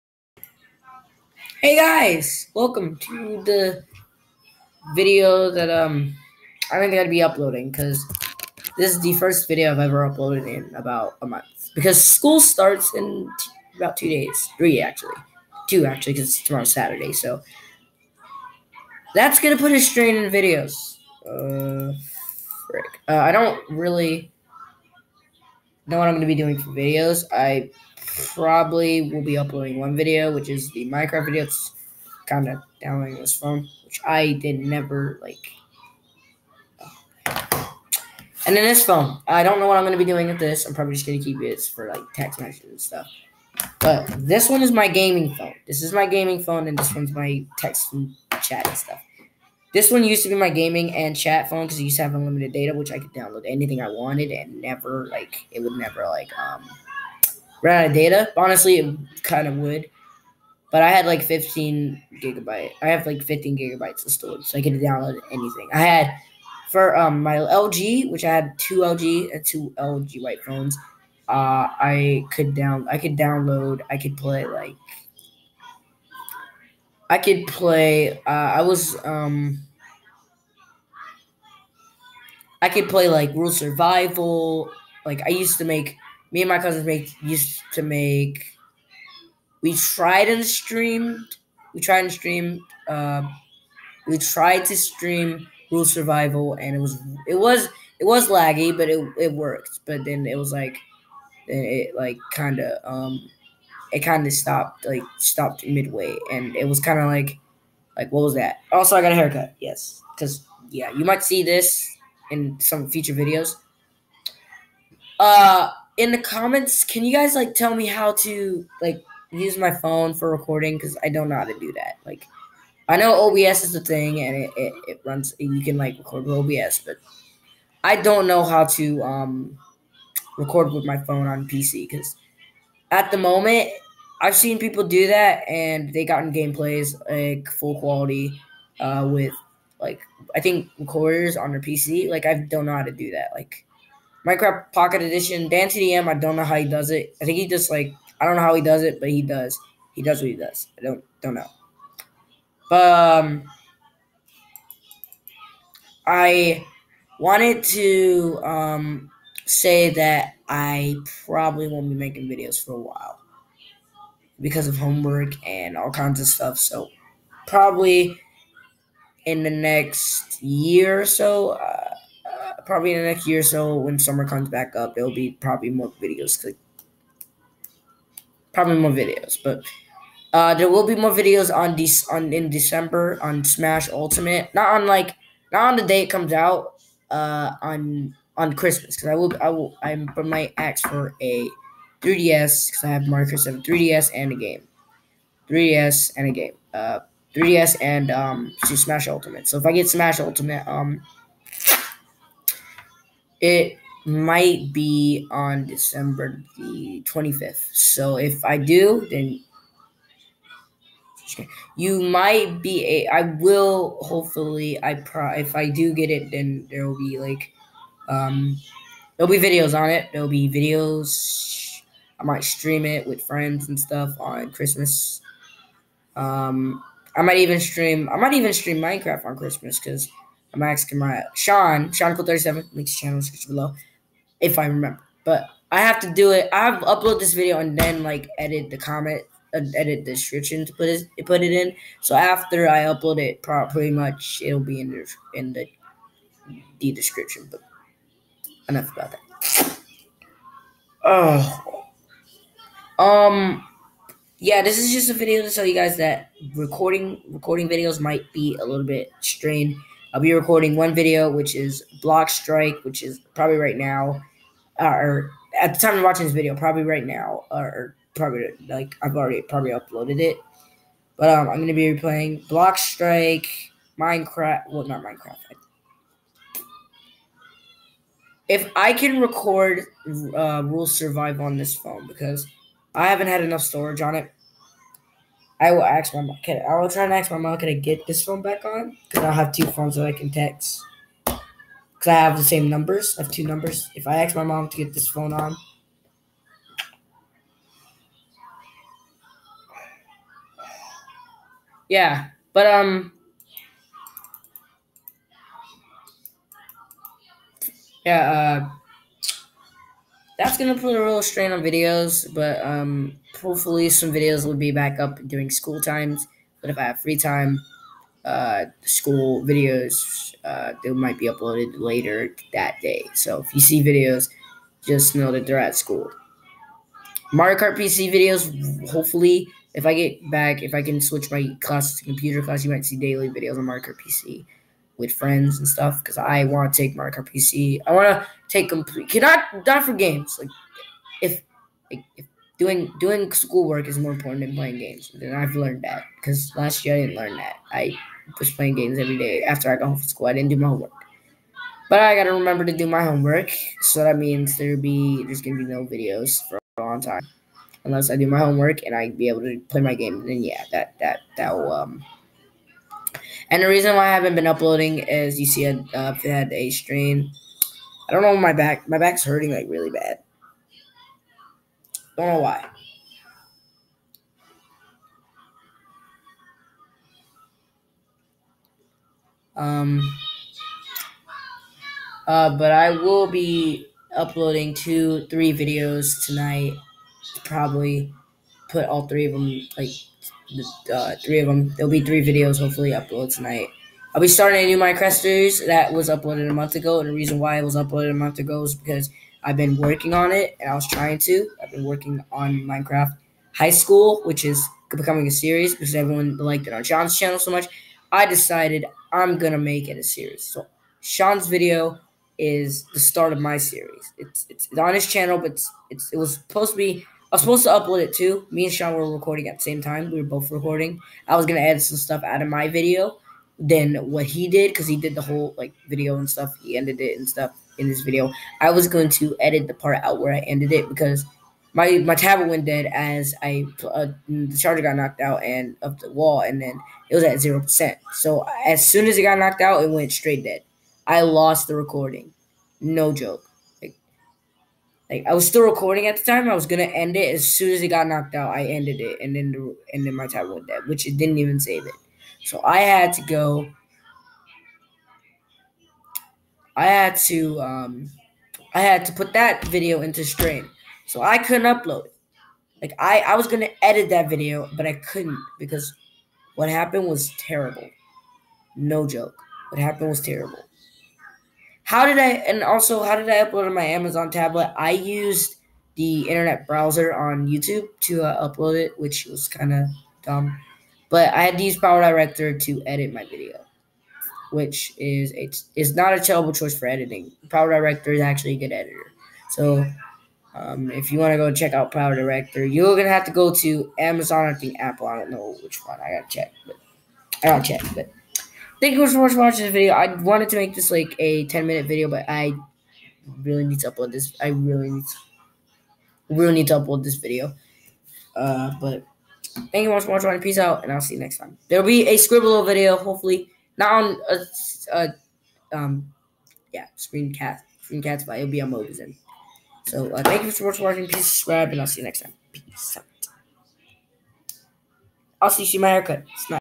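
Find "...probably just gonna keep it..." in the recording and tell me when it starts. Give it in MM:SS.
00:40.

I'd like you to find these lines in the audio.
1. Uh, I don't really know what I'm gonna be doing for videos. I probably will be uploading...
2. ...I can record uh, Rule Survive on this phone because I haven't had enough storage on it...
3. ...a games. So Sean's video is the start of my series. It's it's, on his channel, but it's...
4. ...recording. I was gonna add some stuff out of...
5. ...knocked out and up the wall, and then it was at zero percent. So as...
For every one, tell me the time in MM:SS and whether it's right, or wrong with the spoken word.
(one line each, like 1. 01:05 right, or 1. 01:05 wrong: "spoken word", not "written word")
1. 00:23 right
2. 04:38 right
3. 06:49 wrong: "series", not "games"
4. 07:00 right
5. 07:14 right.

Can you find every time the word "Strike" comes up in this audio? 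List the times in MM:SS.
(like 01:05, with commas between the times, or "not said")
04:22, 04:32.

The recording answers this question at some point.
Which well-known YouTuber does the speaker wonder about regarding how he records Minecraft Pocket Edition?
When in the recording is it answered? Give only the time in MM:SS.
02:25.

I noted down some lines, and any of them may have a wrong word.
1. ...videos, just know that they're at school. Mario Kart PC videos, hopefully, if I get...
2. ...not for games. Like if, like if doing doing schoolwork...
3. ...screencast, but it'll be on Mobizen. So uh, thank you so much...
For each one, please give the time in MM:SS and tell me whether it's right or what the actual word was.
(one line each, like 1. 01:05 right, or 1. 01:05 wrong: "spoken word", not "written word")
1. 05:23 right
2. 05:39 right
3. 08:37 right.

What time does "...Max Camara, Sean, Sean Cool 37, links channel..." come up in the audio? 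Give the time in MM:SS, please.
03:50.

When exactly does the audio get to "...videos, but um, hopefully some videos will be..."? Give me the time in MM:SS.
05:11.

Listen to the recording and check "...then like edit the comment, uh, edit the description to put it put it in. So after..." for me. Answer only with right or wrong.
right.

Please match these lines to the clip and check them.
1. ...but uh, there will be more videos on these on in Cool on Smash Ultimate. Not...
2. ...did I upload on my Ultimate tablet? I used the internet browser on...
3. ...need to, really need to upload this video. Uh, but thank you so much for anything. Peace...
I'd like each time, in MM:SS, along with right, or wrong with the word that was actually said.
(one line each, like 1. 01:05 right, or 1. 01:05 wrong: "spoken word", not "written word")
1. 02:59 wrong: "December", not "Cool"
2. 07:53 wrong: "Amazon", not "Ultimate"
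3. 08:24 wrong: "watching", not "anything".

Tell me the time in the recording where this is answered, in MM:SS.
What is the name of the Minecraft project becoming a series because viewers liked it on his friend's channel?
06:42.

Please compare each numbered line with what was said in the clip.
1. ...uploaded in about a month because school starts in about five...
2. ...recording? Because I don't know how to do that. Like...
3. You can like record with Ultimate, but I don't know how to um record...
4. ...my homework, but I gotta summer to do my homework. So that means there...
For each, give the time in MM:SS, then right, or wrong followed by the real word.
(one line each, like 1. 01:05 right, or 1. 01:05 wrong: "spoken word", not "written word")
1. 00:10 wrong: "two", not "five"
2. 02:00 right
3. 02:05 wrong: "OBS", not "Ultimate"
4. 05:50 wrong: "remember", not "summer".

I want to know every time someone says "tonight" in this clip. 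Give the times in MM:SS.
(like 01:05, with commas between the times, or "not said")
06:26, 06:33.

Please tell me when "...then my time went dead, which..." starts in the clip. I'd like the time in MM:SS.
07:30.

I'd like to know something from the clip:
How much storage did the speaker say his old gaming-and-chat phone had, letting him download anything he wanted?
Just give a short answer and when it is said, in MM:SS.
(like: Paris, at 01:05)
15 gigabytes, at 01:03.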